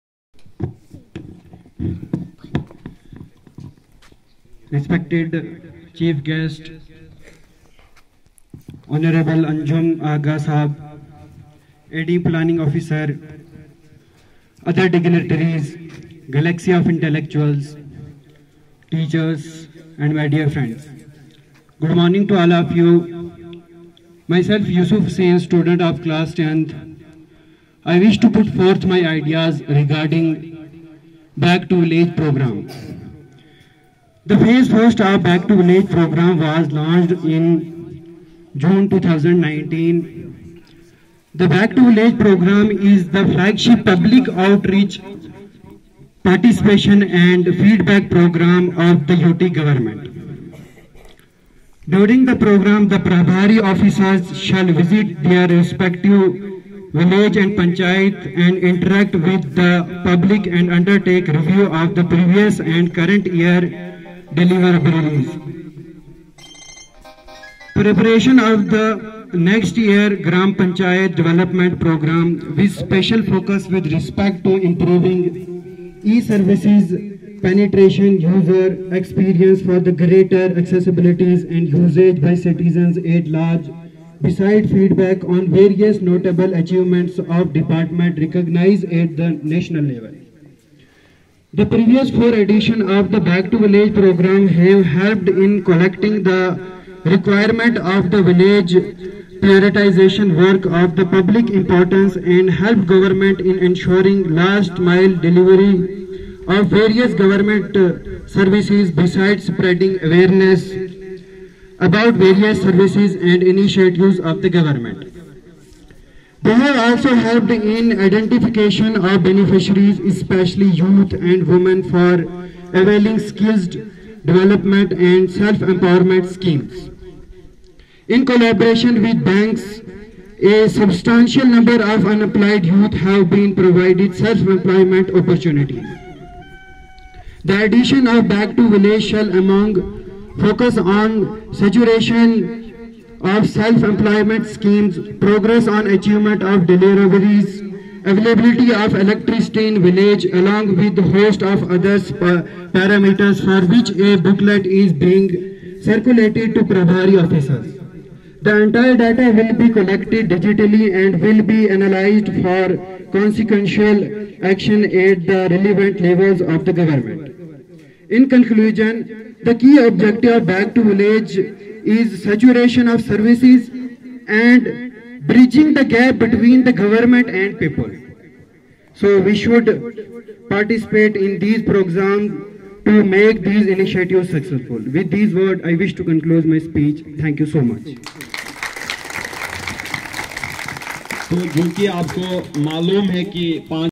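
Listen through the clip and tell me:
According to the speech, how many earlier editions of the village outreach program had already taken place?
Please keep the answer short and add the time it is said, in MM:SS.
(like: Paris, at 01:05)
4, at 01:32.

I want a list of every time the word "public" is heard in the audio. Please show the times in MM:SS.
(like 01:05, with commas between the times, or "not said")
00:43, 01:00, 01:41.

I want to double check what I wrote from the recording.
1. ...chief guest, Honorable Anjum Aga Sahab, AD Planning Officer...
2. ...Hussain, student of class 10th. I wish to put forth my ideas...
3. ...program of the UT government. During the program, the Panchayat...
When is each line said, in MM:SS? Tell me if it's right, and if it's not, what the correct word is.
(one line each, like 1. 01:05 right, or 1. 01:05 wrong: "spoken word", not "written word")
1. 00:05 right
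2. 00:25 right
3. 00:48 wrong: "Prabhari", not "Panchayat".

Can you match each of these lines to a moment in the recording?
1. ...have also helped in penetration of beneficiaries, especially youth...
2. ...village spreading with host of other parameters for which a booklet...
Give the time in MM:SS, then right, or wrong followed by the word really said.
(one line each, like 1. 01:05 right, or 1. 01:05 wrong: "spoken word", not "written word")
1. 01:56 wrong: "identification", not "penetration"
2. 02:29 wrong: "along", not "spreading".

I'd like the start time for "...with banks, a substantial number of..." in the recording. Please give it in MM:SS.
02:09.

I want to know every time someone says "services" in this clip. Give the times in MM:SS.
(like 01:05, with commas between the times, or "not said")
01:16, 01:48, 01:52, 02:53.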